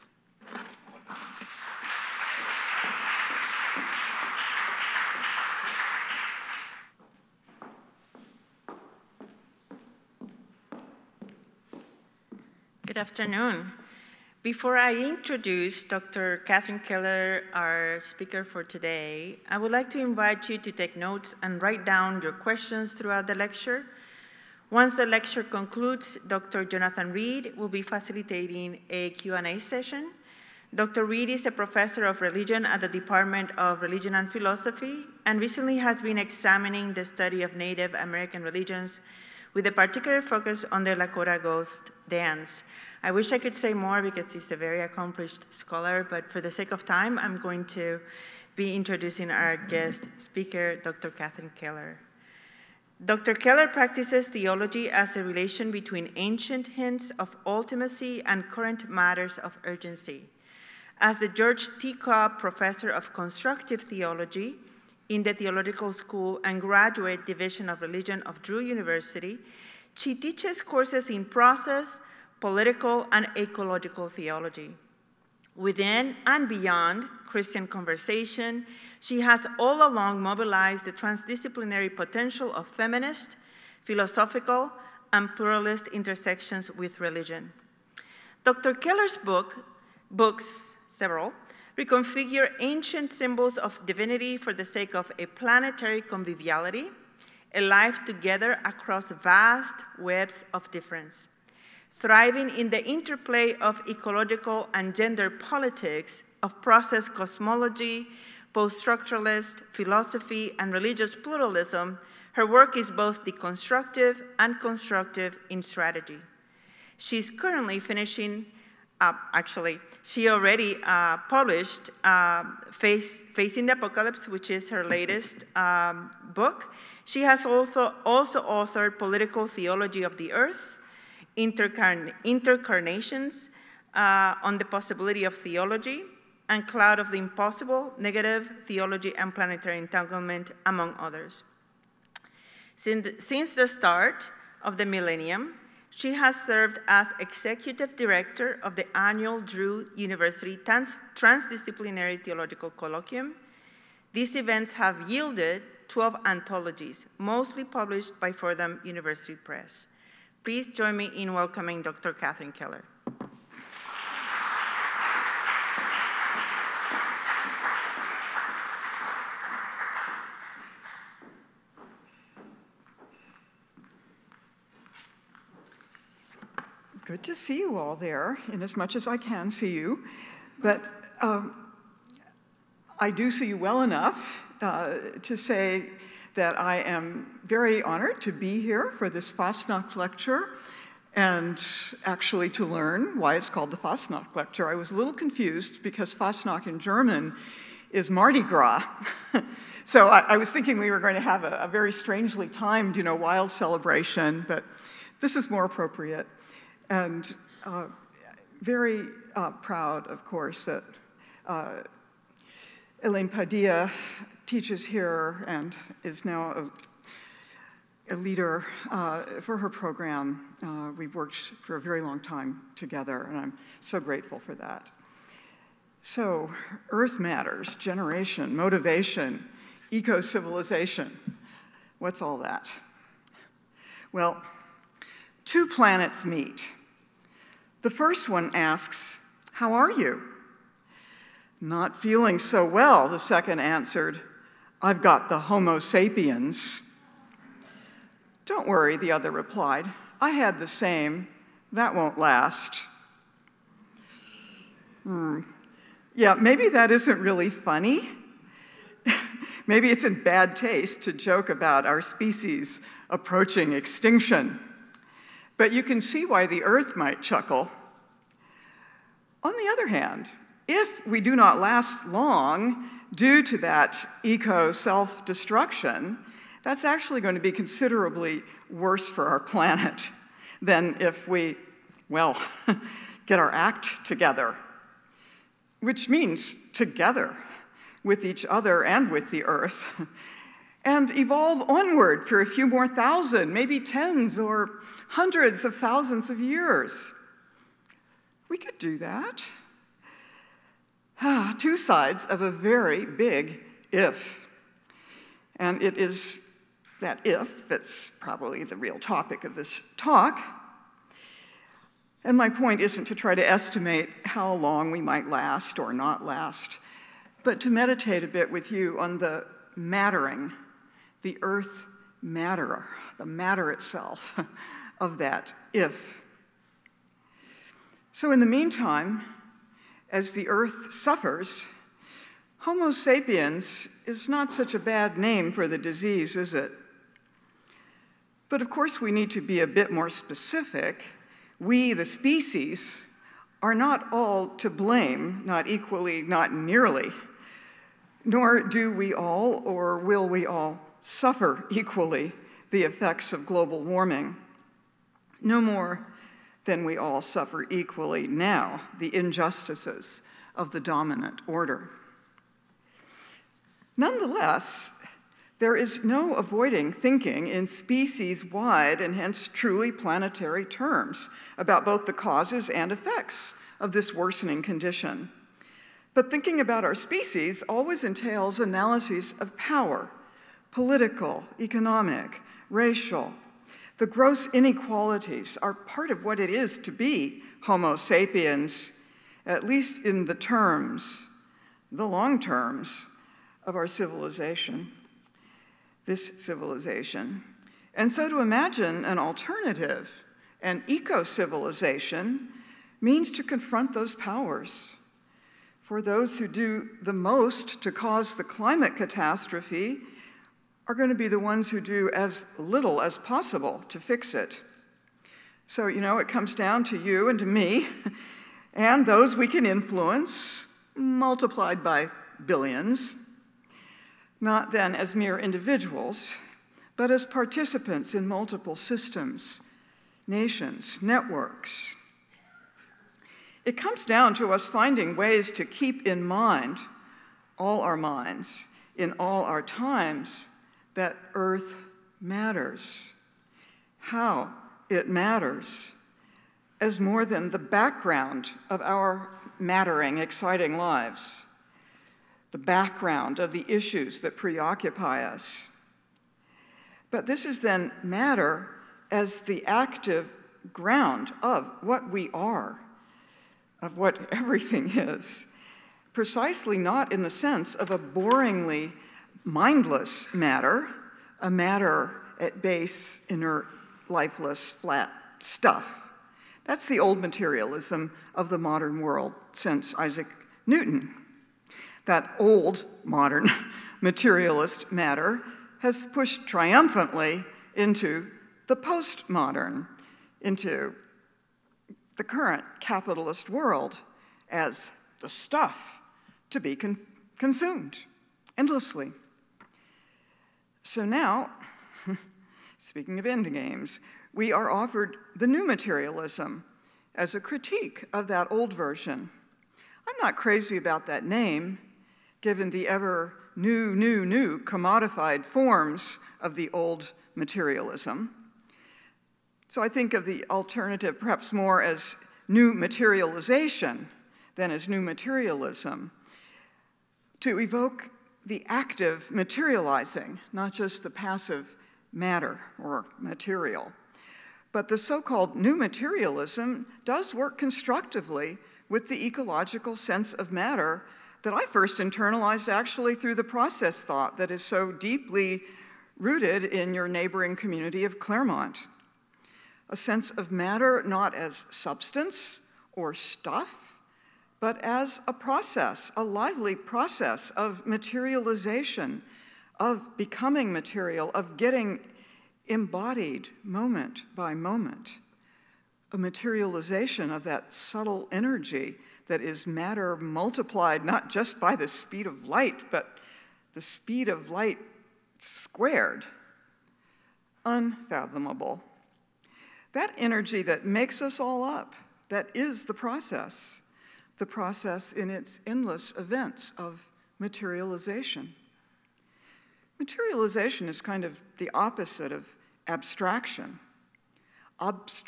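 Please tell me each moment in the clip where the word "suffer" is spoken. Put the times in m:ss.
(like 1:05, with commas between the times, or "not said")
5:30, 5:51, 5:57.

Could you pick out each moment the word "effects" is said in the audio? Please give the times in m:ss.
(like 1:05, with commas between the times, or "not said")
5:52, 6:12.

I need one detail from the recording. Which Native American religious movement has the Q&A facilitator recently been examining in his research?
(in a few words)
Lakota ghost dance.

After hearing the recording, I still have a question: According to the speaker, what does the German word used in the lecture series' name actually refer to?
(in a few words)
Mardi Gras.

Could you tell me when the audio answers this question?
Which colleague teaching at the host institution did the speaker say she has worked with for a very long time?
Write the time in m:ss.
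3:33.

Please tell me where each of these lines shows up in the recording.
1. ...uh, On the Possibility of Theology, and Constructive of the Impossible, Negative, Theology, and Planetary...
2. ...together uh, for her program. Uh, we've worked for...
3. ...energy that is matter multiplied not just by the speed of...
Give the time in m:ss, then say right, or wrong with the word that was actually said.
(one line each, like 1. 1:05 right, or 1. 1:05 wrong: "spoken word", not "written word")
1. 2:13 wrong: "Cloud", not "Constructive"
2. 3:38 wrong: "leader", not "together"
3. 9:28 right.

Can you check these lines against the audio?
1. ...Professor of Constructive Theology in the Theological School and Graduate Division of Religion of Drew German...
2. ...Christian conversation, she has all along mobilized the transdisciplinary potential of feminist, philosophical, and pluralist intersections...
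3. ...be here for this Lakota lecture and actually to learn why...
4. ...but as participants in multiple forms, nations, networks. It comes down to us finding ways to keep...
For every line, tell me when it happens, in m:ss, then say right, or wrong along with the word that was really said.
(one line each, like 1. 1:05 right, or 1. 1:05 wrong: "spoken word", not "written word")
1. 1:02 wrong: "University", not "German"
2. 1:17 right
3. 3:08 wrong: "Fastnacht", not "Lakota"
4. 7:06 wrong: "systems", not "forms".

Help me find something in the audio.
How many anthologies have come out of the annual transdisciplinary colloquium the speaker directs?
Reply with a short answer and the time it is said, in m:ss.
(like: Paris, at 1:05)
12, at 2:35.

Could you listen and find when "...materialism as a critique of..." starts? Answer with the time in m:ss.
8:25.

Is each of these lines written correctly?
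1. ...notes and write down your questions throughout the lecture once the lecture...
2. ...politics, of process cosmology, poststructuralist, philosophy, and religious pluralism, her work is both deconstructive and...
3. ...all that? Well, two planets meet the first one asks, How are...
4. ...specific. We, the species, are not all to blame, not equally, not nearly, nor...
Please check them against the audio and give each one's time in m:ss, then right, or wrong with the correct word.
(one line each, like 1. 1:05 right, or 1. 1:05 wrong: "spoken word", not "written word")
1. 0:20 right
2. 1:45 right
3. 3:52 right
4. 5:40 right.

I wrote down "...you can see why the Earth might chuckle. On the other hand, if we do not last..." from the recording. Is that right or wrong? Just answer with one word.
right.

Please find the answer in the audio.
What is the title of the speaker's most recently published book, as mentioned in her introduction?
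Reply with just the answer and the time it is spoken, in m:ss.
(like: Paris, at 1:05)
Facing the Apocalypse, at 2:03.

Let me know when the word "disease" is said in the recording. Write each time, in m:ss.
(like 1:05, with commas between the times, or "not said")
5:35.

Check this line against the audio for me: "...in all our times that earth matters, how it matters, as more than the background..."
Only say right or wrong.
right.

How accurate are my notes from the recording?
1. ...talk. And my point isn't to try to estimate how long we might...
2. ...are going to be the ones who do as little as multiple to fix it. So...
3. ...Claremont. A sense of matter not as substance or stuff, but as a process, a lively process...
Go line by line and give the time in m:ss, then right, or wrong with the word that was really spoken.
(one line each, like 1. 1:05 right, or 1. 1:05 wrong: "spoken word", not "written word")
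1. 5:09 right
2. 6:50 wrong: "possible", not "multiple"
3. 9:08 right.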